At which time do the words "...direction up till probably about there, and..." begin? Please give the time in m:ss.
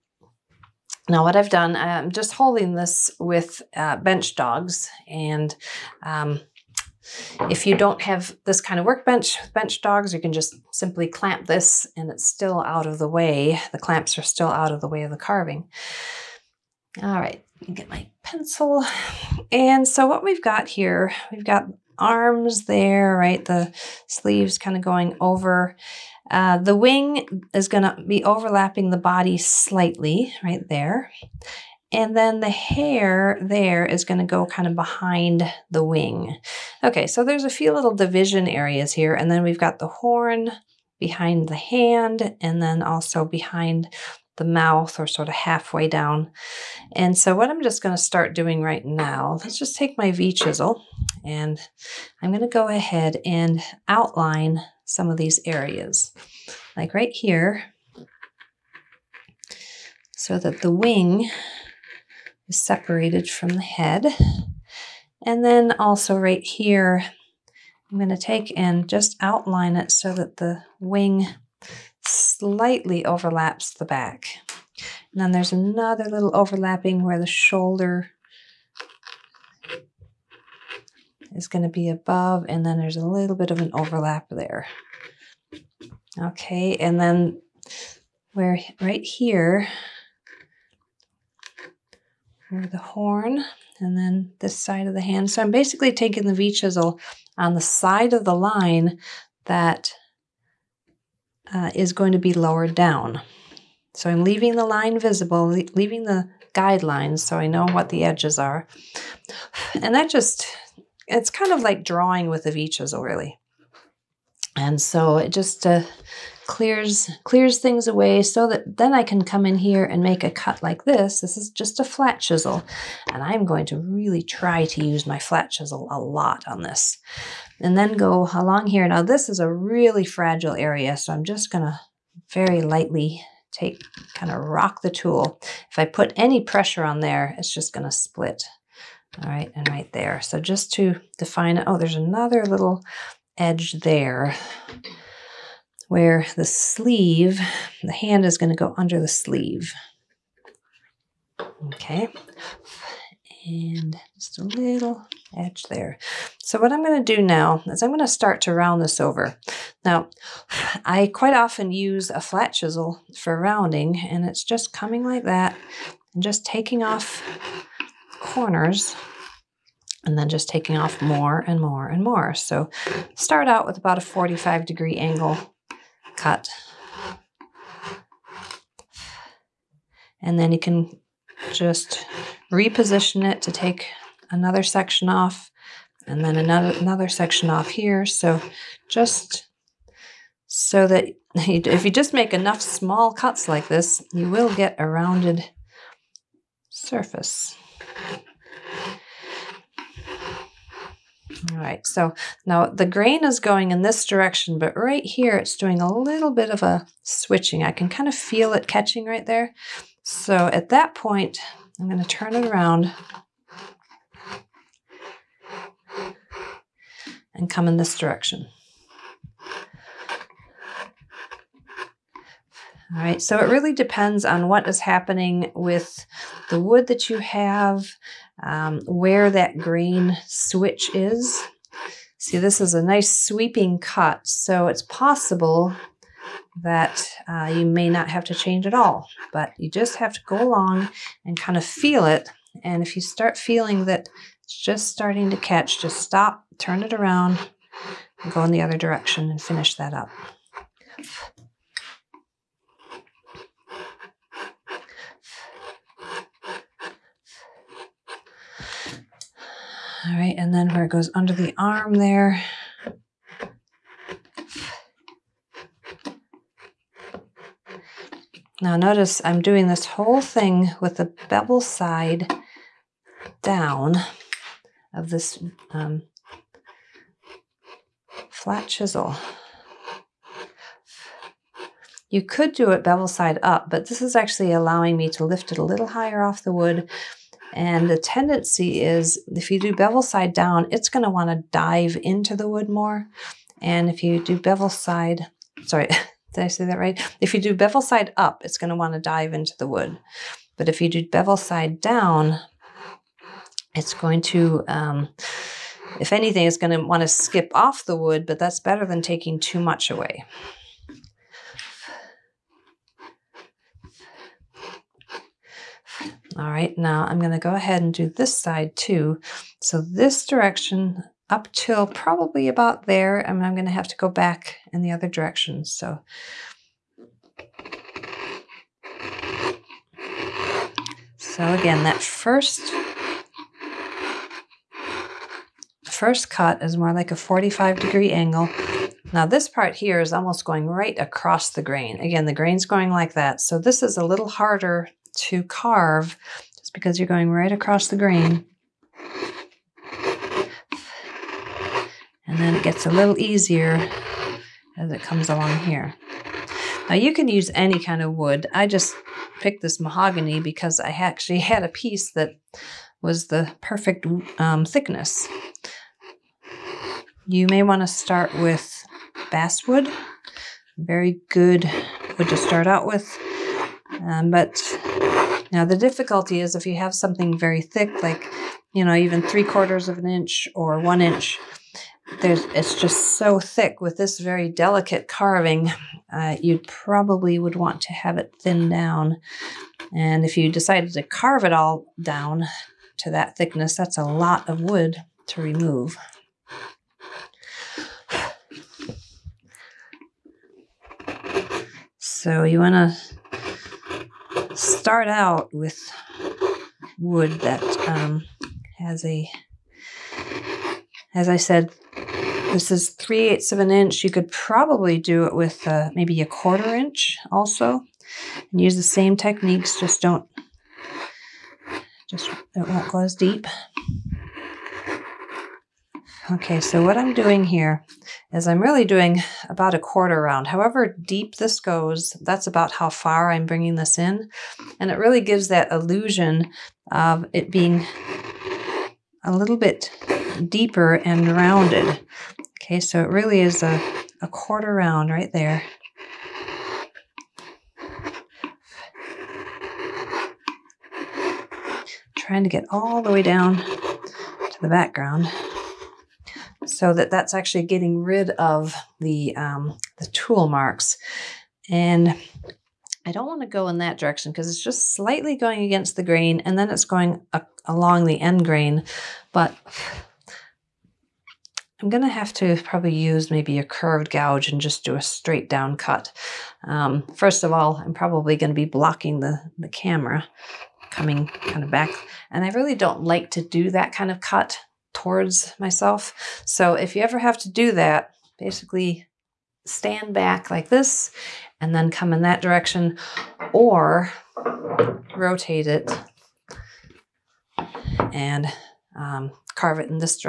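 5:20.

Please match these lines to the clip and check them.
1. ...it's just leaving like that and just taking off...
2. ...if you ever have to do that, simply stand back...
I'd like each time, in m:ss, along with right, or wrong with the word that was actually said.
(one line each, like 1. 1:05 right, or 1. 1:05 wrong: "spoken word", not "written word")
1. 2:44 wrong: "coming", not "leaving"
2. 8:06 wrong: "basically", not "simply".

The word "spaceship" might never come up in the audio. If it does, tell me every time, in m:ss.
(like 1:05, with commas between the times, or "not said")
not said.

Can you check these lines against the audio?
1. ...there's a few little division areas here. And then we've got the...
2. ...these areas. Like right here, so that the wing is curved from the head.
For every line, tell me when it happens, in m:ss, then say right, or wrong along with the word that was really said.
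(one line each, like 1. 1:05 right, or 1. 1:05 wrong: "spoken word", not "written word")
1. 0:37 right
2. 0:55 wrong: "separated", not "curved".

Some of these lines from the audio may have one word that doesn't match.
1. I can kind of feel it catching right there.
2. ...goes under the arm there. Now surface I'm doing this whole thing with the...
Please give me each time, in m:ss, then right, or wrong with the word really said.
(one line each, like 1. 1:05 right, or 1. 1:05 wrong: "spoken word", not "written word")
1. 3:27 right
2. 4:20 wrong: "notice", not "surface".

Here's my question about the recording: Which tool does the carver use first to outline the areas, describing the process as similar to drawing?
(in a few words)
V chisel.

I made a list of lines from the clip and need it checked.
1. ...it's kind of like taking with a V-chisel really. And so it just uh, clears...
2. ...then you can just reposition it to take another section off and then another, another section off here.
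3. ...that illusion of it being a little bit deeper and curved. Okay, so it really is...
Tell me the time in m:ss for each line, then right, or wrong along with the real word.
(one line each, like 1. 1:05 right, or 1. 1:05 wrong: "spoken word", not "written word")
1. 1:51 wrong: "drawing", not "taking"
2. 3:00 right
3. 7:15 wrong: "rounded", not "curved".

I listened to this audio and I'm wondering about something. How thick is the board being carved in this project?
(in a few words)
3/8 inch.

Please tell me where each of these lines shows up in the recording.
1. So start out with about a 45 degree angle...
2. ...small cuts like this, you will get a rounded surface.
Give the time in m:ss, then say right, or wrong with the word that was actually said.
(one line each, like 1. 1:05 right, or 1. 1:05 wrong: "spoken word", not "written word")
1. 2:52 right
2. 3:12 right.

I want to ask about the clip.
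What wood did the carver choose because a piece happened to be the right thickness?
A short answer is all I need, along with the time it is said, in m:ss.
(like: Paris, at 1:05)
Mahogany, at 5:59.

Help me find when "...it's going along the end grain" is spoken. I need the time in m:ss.
7:46.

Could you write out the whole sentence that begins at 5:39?
Now this part here is almost going right across the grain.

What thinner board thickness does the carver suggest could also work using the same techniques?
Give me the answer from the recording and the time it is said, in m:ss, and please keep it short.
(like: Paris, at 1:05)
1/4 inch, at 6:56.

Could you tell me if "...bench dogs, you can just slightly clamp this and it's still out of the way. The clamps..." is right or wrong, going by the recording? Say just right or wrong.
wrong.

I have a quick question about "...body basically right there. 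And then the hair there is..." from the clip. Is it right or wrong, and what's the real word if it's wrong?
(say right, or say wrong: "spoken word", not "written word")
wrong: "slightly", not "basically".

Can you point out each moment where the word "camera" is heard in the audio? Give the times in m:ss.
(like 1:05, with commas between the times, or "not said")
7:59.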